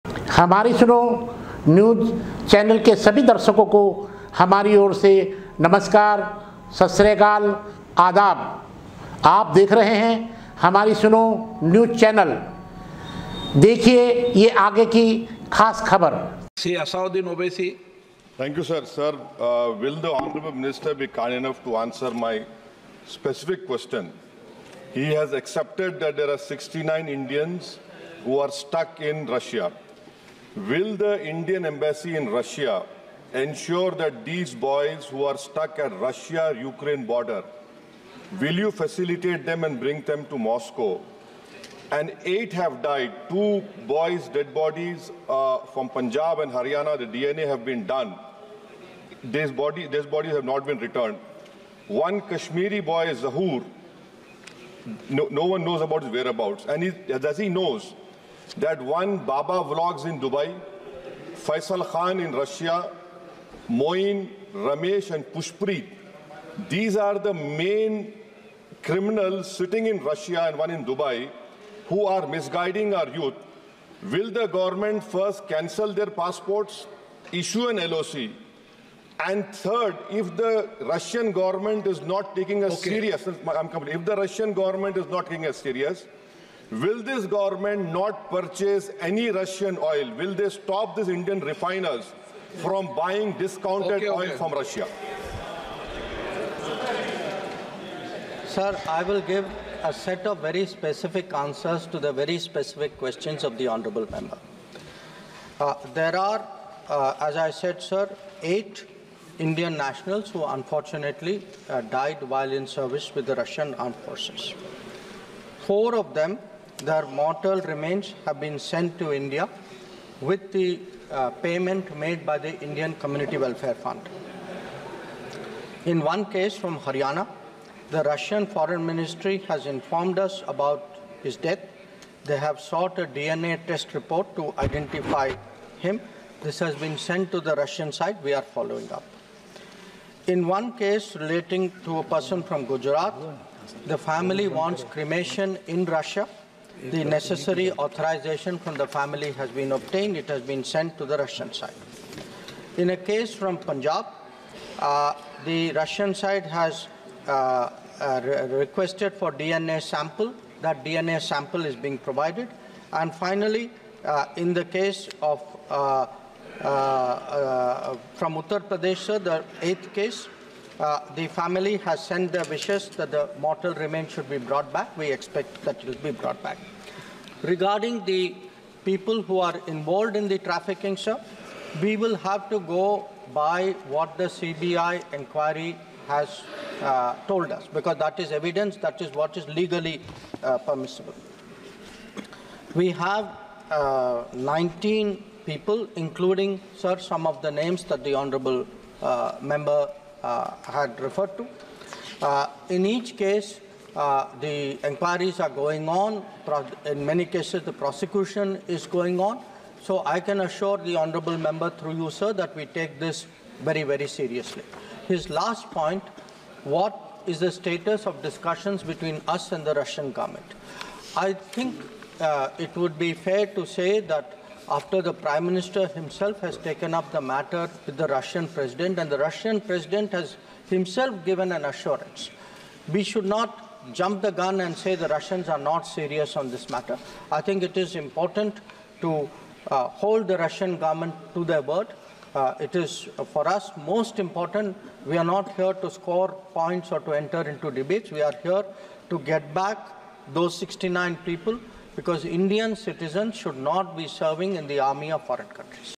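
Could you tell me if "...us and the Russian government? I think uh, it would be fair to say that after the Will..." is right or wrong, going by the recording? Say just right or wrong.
wrong.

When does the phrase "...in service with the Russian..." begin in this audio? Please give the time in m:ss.
1:52.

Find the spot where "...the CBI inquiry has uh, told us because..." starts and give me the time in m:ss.
3:04.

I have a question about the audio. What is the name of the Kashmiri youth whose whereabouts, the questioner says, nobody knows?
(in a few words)
Zahur.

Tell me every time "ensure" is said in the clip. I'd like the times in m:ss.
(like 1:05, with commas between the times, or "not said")
0:33.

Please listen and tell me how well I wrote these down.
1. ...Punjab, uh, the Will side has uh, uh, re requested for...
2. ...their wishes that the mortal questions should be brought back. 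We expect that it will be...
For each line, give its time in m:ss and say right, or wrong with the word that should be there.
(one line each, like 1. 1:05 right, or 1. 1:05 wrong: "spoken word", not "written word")
1. 2:33 wrong: "Russian", not "Will"
2. 2:52 wrong: "remains", not "questions".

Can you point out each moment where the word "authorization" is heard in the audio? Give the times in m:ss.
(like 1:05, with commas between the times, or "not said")
2:27.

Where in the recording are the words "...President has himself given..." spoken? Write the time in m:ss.
3:49.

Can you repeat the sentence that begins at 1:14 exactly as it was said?
Will the government first cancel their passports, issue an LOC, and third, if the Russian government is not taking us okay.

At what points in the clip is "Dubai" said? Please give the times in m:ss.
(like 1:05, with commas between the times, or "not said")
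1:00, 1:10.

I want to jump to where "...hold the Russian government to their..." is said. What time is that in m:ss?
3:59.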